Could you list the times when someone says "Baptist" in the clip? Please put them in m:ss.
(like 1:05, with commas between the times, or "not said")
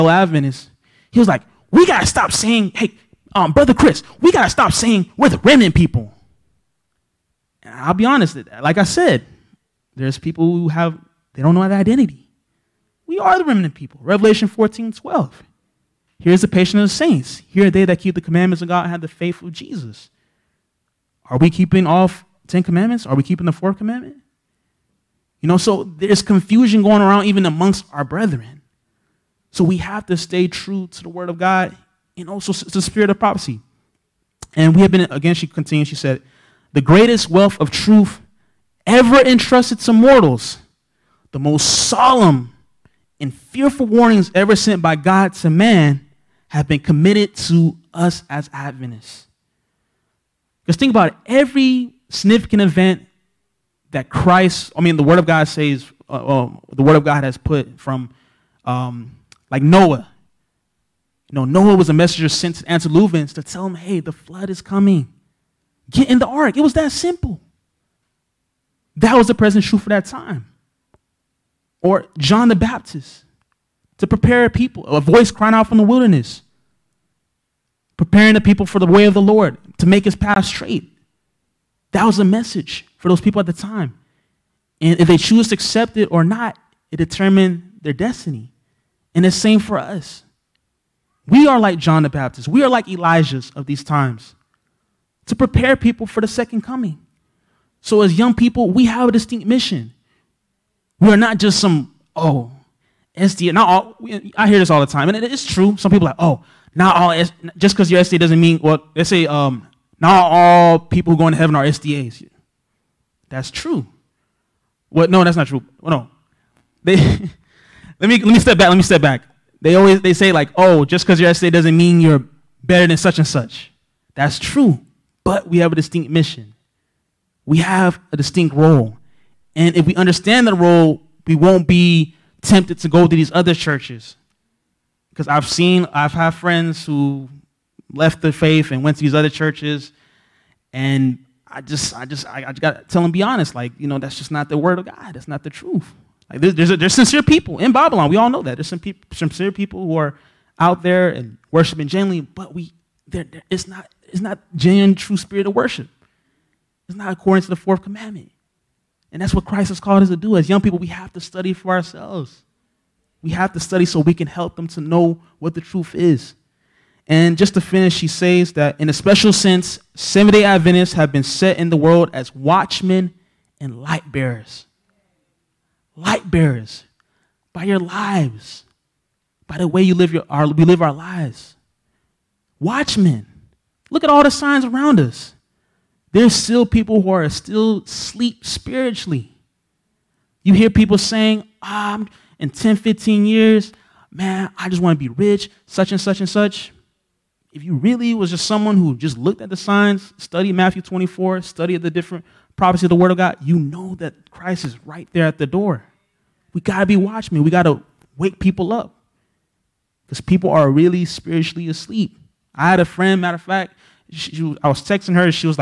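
1:12, 1:32.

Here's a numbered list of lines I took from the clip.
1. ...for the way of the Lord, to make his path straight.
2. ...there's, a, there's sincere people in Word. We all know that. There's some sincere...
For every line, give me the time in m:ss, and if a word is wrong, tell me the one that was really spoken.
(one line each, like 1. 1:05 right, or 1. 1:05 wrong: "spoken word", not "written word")
1. 1:18 right
2. 2:26 wrong: "Babylon", not "Word".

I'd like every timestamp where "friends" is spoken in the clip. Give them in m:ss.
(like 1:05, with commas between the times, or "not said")
2:16, 3:32.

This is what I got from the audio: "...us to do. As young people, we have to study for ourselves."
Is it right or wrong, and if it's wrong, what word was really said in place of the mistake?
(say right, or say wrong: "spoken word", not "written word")
right.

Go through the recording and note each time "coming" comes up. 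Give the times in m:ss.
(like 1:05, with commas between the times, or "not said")
1:04, 1:36.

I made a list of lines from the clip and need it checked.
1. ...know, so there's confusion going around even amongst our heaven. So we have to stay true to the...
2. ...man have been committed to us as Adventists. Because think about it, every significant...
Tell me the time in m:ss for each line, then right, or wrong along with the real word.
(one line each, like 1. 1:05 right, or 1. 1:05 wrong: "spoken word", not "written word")
1. 0:25 wrong: "brethren", not "heaven"
2. 0:45 right.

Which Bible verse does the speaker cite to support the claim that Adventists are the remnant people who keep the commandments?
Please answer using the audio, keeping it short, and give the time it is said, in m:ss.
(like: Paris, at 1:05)
Revelation 14:12, at 0:14.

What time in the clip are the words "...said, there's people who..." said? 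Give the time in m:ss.
0:08.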